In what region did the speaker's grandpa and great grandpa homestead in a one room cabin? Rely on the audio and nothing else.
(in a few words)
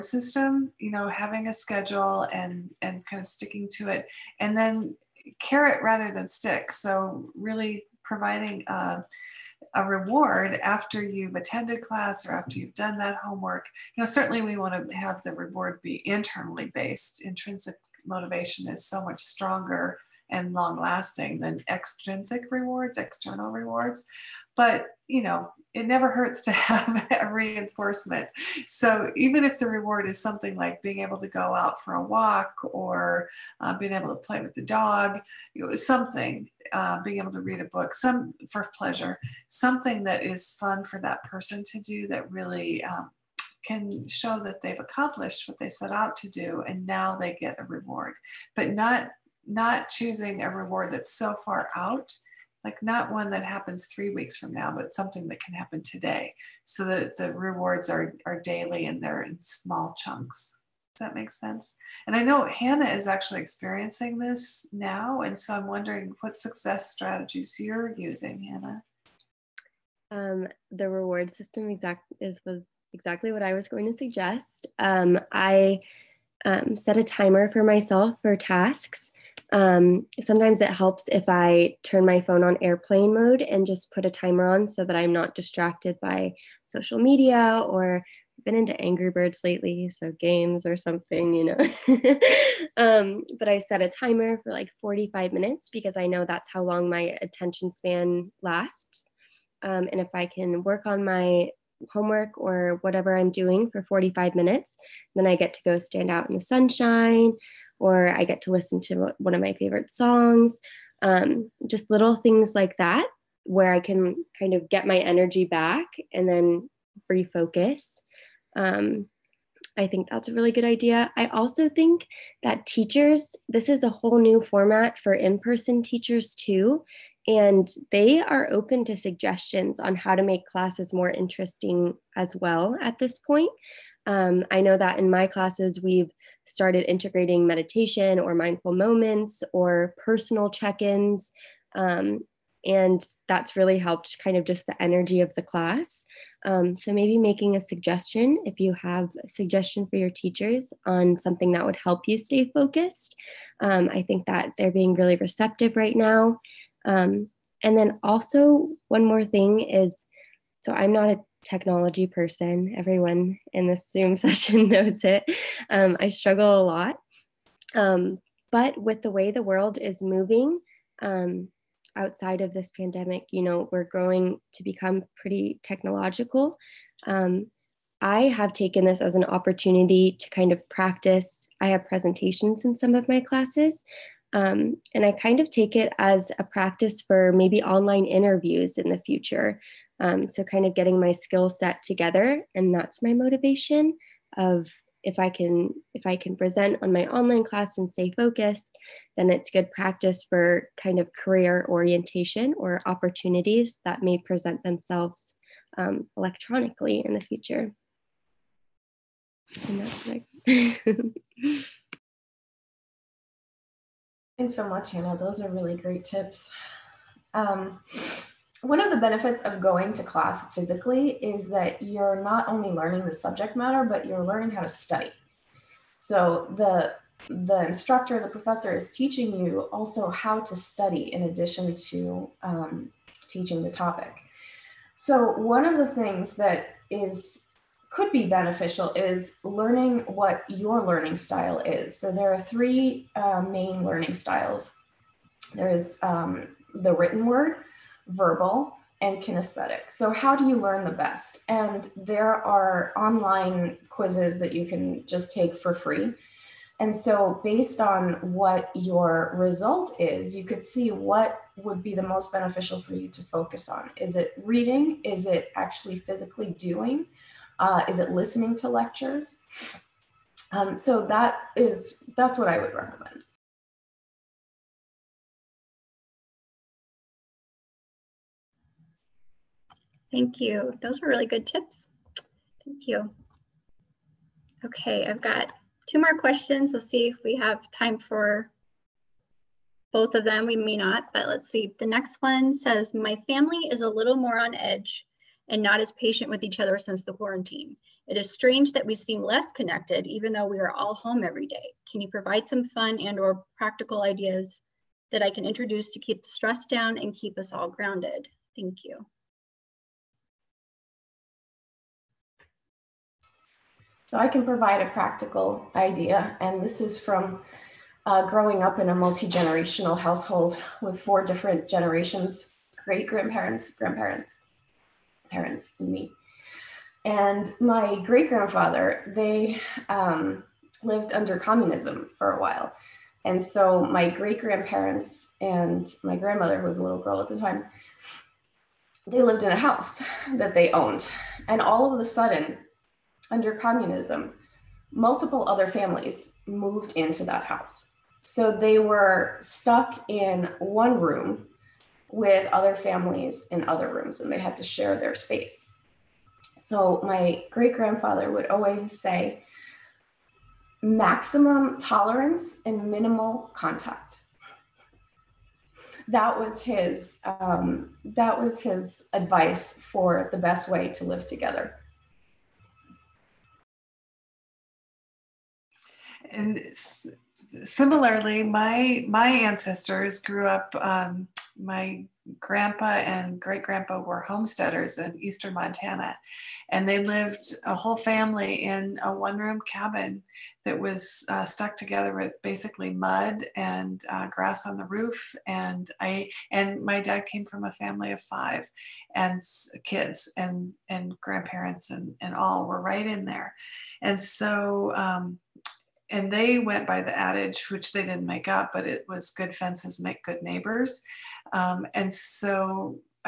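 eastern Montana.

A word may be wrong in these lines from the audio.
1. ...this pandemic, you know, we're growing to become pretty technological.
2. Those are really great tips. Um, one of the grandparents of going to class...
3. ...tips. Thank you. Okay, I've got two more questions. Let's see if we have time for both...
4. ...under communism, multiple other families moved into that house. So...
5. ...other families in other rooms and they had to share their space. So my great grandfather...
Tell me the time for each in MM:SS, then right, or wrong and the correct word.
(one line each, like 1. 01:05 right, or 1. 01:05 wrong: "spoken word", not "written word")
1. 02:52 right
2. 03:35 wrong: "benefits", not "grandparents"
3. 04:41 right
4. 05:43 right
5. 05:52 right.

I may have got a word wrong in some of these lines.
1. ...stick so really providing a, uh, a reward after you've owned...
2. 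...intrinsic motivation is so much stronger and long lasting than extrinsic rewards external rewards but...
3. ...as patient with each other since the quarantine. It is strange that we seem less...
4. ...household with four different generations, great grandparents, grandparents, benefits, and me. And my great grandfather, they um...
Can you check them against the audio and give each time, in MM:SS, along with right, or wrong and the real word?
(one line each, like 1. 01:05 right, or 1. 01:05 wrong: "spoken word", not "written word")
1. 00:06 wrong: "attended", not "owned"
2. 00:17 right
3. 04:55 right
4. 05:19 wrong: "parents", not "benefits".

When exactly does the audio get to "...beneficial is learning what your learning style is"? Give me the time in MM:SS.
03:58.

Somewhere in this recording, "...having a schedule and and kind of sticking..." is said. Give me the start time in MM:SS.
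00:01.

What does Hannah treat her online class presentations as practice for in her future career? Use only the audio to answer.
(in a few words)
online interviews.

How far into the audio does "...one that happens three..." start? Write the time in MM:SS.
00:53.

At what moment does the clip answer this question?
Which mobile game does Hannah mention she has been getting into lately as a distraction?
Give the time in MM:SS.
01:28.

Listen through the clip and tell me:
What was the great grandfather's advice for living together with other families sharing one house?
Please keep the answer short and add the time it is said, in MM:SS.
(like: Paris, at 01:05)
maximum tolerance and minimal contact, at 06:00.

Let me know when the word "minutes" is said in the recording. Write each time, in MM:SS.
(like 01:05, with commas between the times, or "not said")
01:35, 01:44.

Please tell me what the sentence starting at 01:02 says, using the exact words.
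And I know Hannah is actually experiencing this now.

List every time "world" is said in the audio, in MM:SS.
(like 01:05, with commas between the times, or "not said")
02:49.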